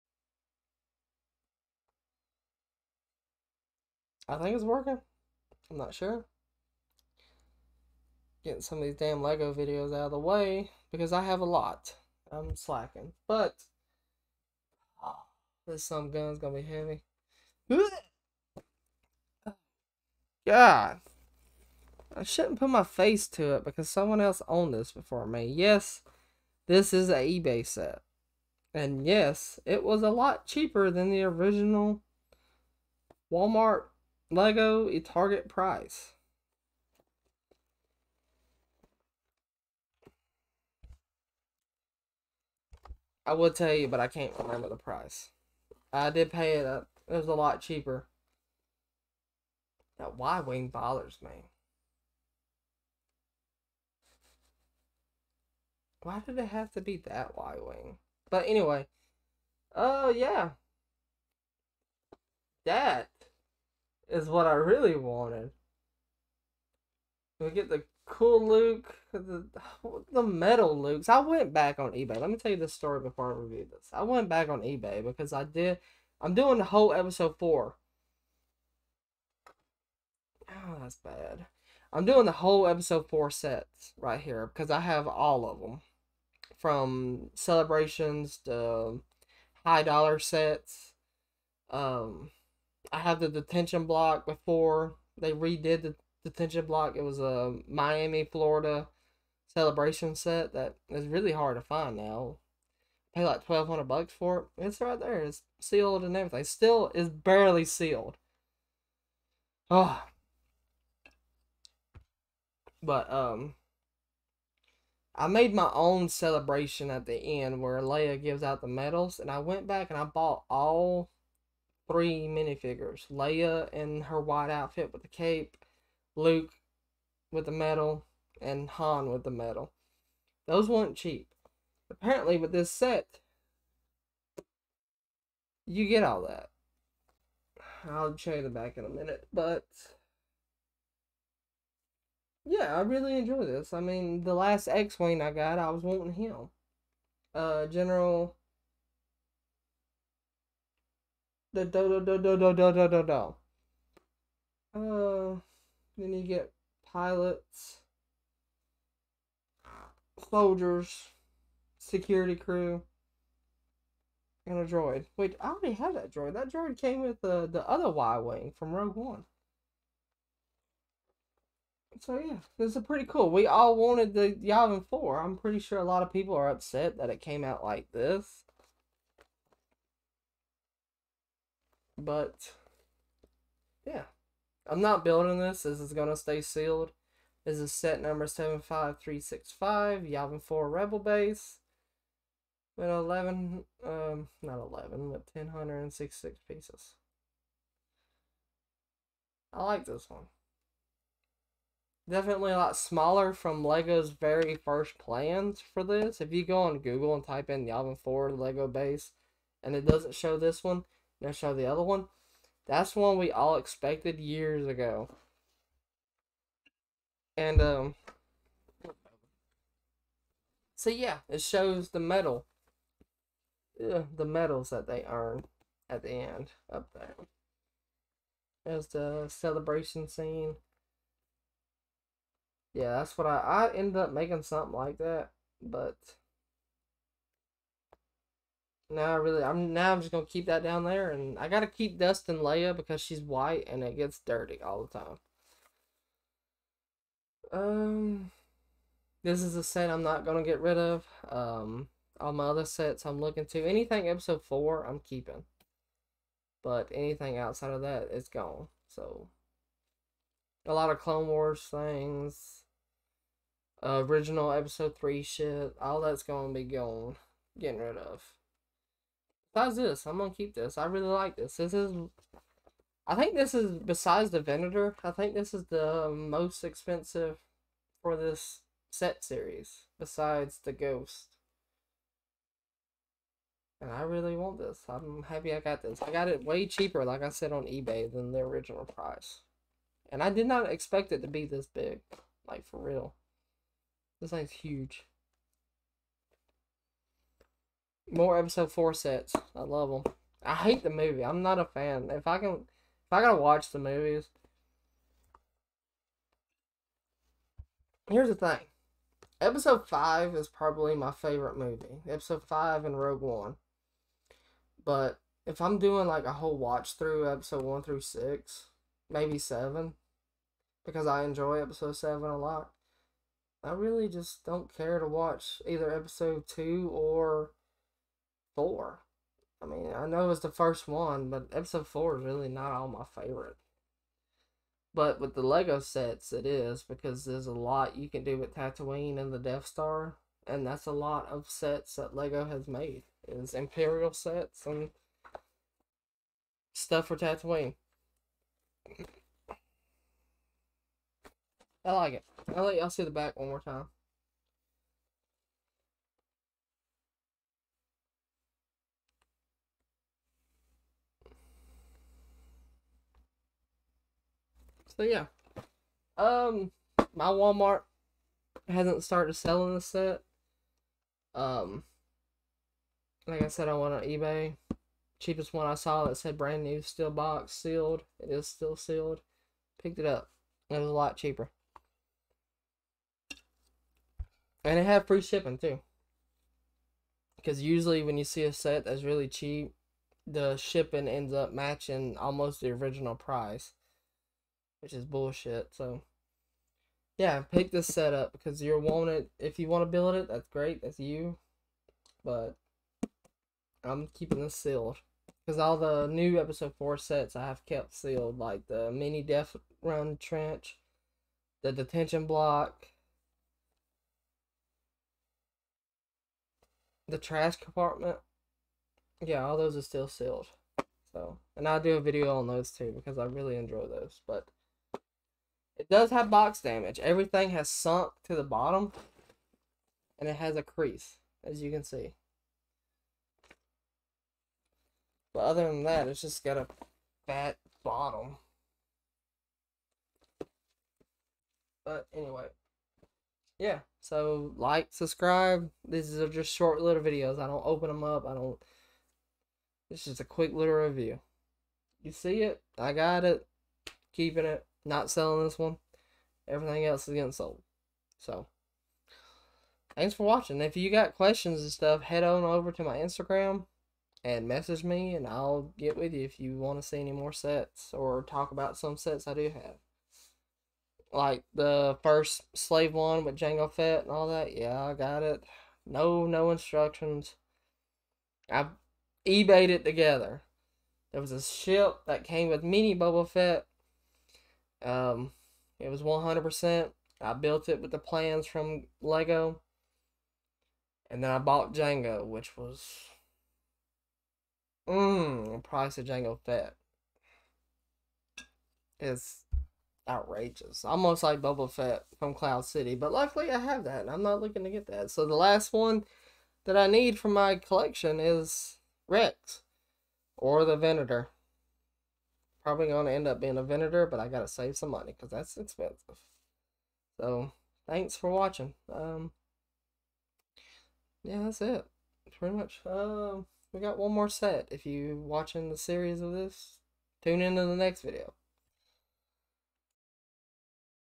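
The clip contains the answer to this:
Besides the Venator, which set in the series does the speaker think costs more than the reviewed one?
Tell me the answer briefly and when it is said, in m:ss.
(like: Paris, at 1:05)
The Ghost, at 4:40.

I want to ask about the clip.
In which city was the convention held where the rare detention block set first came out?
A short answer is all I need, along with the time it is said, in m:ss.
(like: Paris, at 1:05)
Miami, at 1:37.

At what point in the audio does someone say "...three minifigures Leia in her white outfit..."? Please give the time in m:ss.
2:01.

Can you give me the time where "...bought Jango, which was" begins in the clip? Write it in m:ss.
8:11.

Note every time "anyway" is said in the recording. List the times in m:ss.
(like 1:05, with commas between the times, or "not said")
0:58, 7:22.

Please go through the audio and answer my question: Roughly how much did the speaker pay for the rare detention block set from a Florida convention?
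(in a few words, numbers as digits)
1200 dollars.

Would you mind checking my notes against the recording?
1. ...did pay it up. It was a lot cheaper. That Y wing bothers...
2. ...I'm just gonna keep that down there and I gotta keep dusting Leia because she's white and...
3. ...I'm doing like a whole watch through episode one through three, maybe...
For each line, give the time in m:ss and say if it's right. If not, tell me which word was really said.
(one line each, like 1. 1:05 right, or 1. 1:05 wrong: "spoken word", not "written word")
1. 0:46 right
2. 3:59 right
3. 5:15 wrong: "six", not "three".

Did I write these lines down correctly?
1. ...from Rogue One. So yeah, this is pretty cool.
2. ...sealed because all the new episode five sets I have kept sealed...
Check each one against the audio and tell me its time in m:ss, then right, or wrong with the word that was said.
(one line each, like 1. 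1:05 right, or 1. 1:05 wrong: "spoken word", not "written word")
1. 2:48 right
2. 6:44 wrong: "four", not "five".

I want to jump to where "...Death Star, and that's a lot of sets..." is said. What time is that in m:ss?
5:39.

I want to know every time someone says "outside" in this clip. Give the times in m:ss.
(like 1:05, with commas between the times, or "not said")
4:17.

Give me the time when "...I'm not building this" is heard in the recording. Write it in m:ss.
3:04.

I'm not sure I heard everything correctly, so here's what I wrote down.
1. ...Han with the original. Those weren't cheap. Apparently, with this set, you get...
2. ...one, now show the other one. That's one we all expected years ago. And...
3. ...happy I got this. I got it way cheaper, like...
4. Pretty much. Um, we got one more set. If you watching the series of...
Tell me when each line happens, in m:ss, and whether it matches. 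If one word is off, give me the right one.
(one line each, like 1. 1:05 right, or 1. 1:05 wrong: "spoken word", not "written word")
1. 2:08 wrong: "medal", not "original"
2. 3:30 right
3. 4:45 right
4. 8:42 right.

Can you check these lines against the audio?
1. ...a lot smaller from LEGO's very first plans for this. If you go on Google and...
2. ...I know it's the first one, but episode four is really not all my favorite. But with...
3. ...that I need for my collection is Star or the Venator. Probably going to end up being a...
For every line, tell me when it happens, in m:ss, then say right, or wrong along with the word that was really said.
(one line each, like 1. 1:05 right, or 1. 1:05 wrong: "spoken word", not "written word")
1. 3:22 right
2. 5:29 right
3. 8:26 wrong: "Rex", not "Star".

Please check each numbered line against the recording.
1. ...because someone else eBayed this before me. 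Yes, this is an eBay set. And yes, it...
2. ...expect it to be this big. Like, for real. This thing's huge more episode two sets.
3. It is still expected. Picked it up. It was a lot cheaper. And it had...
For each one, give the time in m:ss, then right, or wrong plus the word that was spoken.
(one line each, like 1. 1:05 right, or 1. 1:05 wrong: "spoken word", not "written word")
1. 0:23 wrong: "owned", not "eBayed"
2. 4:50 wrong: "four", not "two"
3. 6:18 wrong: "sealed", not "expected".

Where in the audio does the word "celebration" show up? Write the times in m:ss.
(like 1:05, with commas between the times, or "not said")
1:27, 1:39, 1:56, 3:49.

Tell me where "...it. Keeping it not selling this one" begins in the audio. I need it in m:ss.
7:33.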